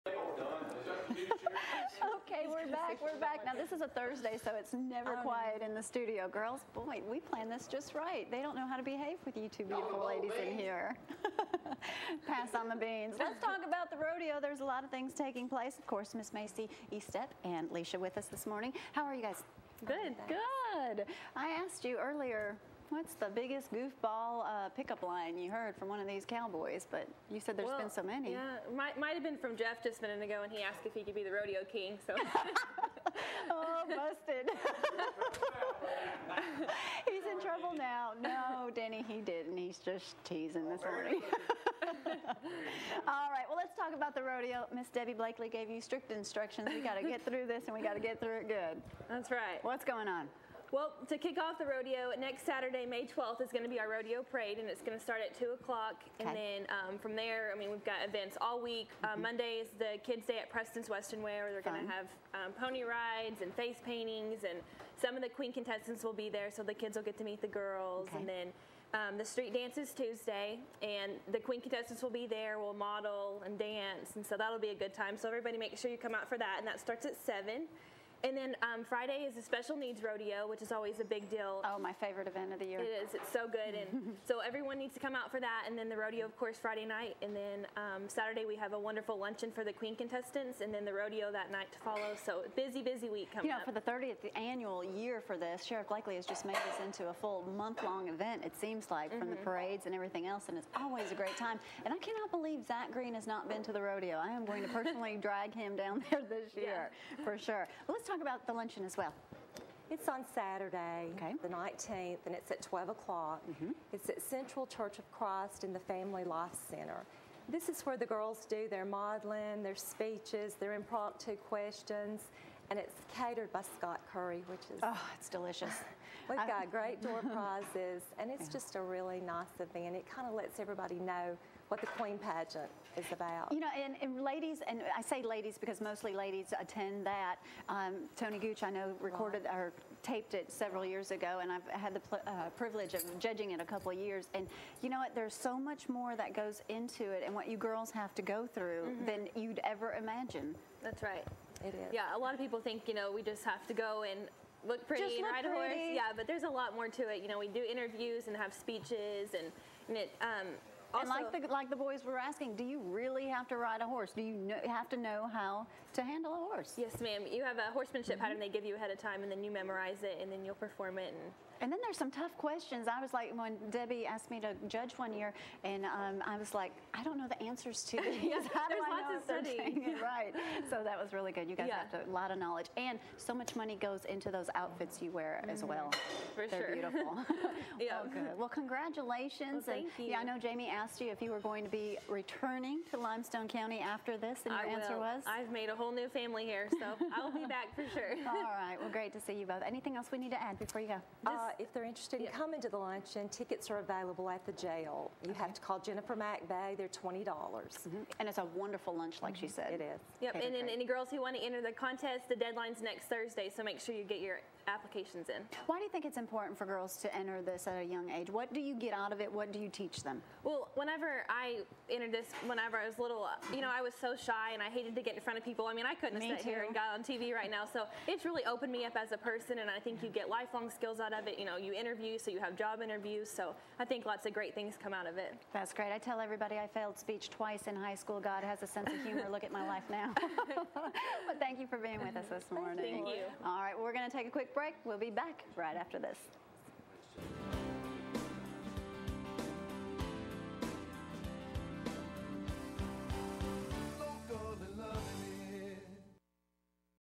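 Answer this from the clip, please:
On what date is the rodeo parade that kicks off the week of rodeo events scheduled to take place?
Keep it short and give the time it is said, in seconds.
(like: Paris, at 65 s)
May 12th, at 52 s.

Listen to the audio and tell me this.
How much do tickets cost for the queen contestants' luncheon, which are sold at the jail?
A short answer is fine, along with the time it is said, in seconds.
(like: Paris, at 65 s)
$20, at 206 s.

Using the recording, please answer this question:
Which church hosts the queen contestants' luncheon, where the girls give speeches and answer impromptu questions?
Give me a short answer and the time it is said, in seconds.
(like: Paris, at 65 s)
Central Church of Christ, at 114 s.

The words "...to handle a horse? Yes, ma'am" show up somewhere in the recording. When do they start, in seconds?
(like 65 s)
165 s.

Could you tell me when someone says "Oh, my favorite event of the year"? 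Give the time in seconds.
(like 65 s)
81 s.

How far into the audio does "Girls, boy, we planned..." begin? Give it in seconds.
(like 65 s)
6 s.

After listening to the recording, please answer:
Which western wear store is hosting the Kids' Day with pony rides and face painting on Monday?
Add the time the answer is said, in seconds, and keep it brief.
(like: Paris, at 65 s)
Preston's Western Wear, at 60 s.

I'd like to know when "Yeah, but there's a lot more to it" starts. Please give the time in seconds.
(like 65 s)
155 s.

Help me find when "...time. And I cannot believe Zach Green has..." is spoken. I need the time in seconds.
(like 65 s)
101 s.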